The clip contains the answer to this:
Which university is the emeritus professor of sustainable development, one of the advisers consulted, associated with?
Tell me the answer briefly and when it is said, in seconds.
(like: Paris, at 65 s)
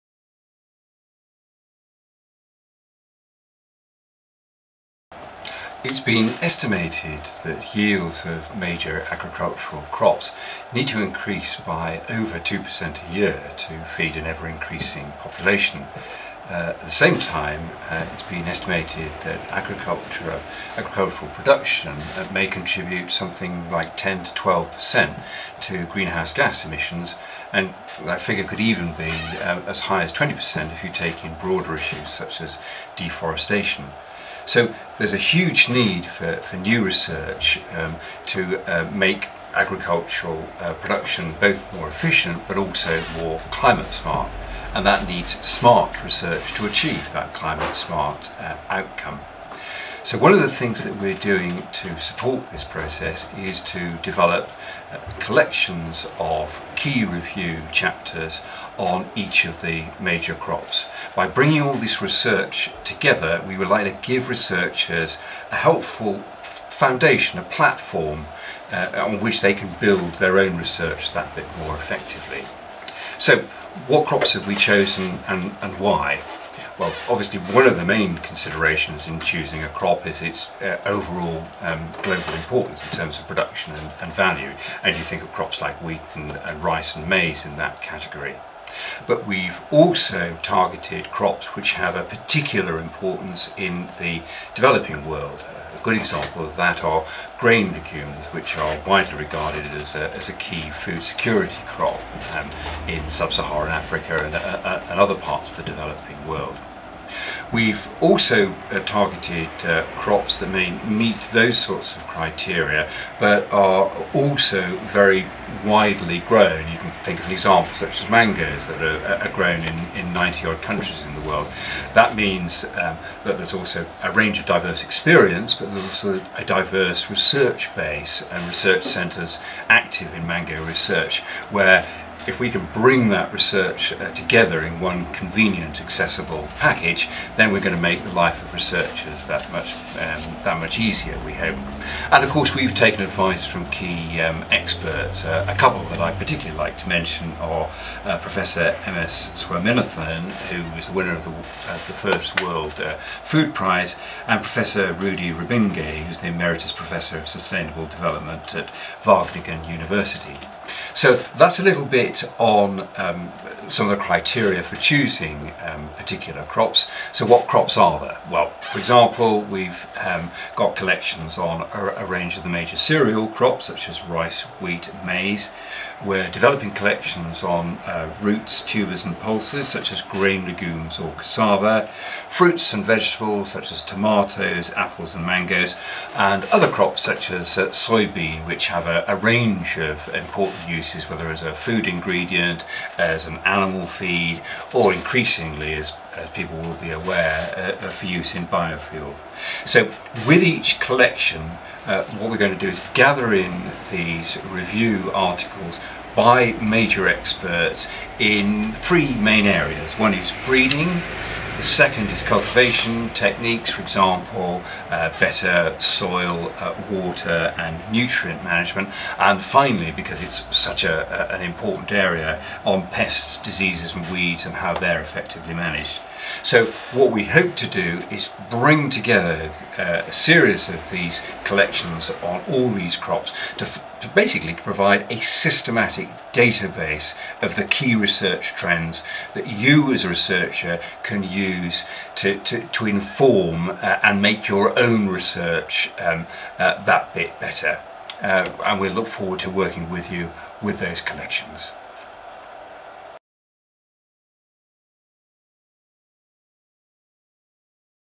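Wageningen University, at 159 s.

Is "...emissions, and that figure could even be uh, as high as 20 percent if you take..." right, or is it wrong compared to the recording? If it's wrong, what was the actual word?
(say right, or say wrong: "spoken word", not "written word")
right.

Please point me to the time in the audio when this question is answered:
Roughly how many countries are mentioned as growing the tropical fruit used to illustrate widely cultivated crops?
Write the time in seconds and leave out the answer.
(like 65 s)
120 s.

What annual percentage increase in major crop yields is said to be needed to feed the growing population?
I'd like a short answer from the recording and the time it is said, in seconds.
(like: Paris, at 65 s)
over 2%, at 12 s.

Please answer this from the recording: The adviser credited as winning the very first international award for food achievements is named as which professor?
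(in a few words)
M.S. Swaminathan.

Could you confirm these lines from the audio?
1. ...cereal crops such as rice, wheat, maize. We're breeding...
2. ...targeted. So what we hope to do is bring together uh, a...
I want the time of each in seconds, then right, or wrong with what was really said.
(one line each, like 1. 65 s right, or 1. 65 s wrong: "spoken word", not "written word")
1. 172 s wrong: "developing", not "breeding"
2. 225 s wrong: "managed", not "targeted".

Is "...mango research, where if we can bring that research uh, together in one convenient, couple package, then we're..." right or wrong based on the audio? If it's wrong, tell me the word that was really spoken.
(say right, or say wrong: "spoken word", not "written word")
wrong: "accessible", not "couple".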